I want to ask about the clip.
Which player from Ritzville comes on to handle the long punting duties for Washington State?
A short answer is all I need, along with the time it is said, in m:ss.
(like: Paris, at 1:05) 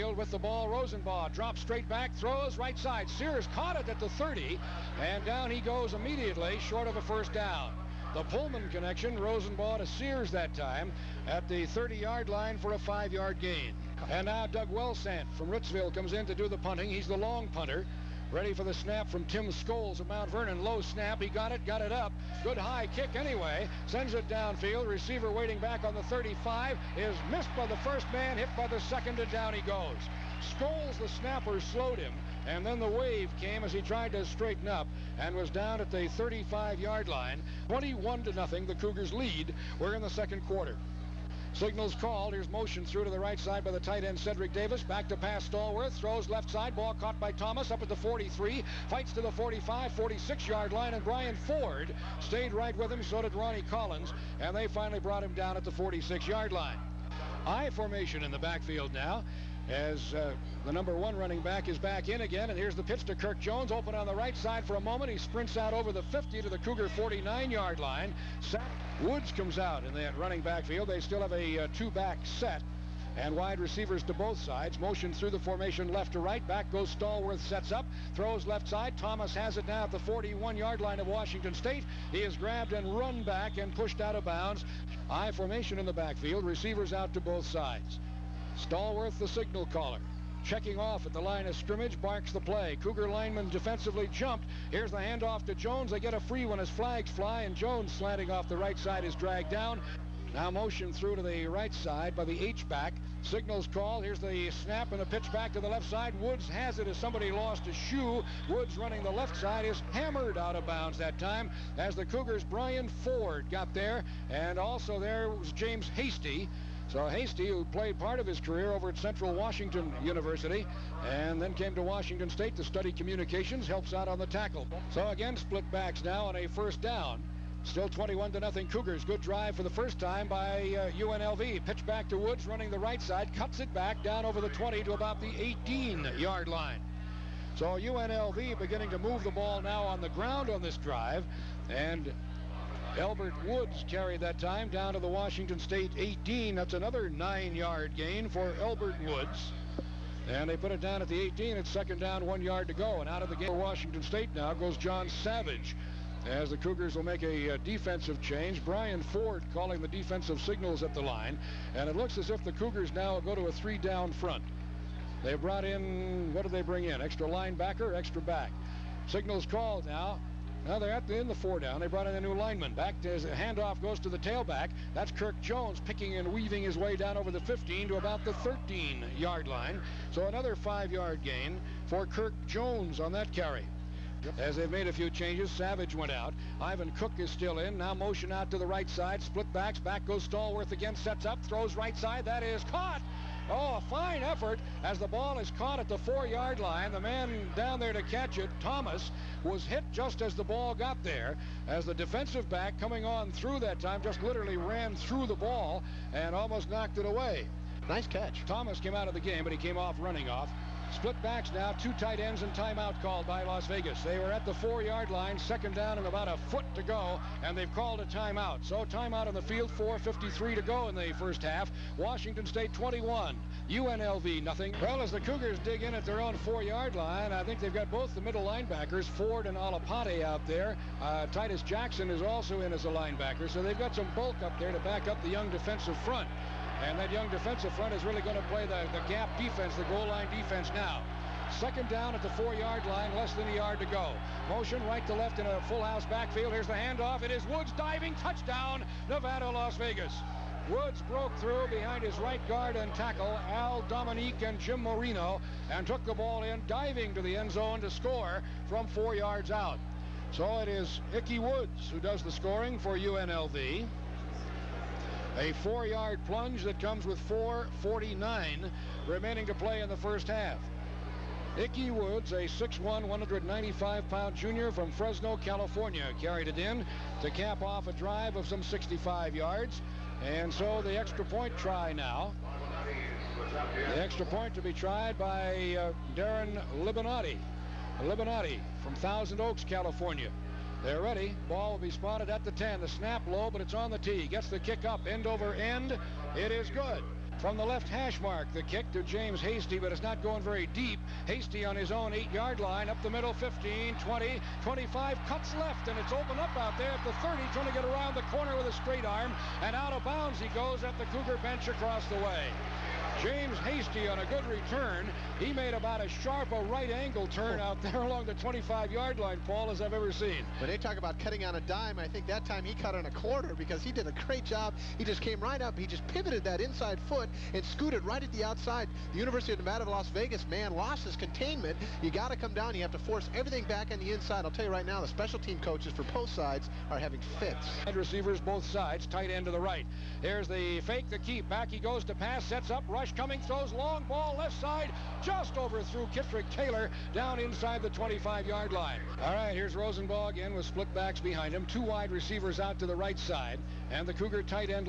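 Doug Wellsant, at 0:14.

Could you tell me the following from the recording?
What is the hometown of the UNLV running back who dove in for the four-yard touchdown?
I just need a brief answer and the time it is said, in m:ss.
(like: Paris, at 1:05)
Fresno, California, at 4:34.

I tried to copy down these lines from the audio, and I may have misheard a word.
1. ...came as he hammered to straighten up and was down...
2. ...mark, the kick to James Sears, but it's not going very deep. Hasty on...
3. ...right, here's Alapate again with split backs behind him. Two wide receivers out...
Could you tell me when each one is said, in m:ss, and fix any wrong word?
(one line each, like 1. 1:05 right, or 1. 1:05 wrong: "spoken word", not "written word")
1. 0:33 wrong: "tried", not "hammered"
2. 4:58 wrong: "Hasty", not "Sears"
3. 5:49 wrong: "Rosenbach", not "Alapate".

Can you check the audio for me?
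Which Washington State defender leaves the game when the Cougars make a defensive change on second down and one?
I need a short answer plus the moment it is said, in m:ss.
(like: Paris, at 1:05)
John Savage, at 2:34.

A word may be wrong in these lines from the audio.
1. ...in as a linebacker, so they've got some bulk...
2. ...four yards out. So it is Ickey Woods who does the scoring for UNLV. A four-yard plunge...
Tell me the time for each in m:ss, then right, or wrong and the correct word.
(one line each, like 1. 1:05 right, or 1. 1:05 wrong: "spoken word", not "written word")
1. 3:52 right
2. 4:18 right.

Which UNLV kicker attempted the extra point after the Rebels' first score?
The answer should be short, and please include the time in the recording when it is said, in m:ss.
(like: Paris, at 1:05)
Darren Libinati, at 4:46.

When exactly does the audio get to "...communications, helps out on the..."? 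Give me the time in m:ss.
2:02.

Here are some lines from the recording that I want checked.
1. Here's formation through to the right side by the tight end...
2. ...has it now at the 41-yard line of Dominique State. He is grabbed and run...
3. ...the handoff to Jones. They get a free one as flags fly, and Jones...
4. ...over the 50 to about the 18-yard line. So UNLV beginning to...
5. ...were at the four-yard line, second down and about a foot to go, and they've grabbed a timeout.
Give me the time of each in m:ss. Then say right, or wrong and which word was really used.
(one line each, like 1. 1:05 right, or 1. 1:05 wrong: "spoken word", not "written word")
1. 0:42 wrong: "motion", not "formation"
2. 1:19 wrong: "Washington", not "Dominique"
3. 1:34 right
4. 2:14 wrong: "20", not "50"
5. 3:34 wrong: "called", not "grabbed".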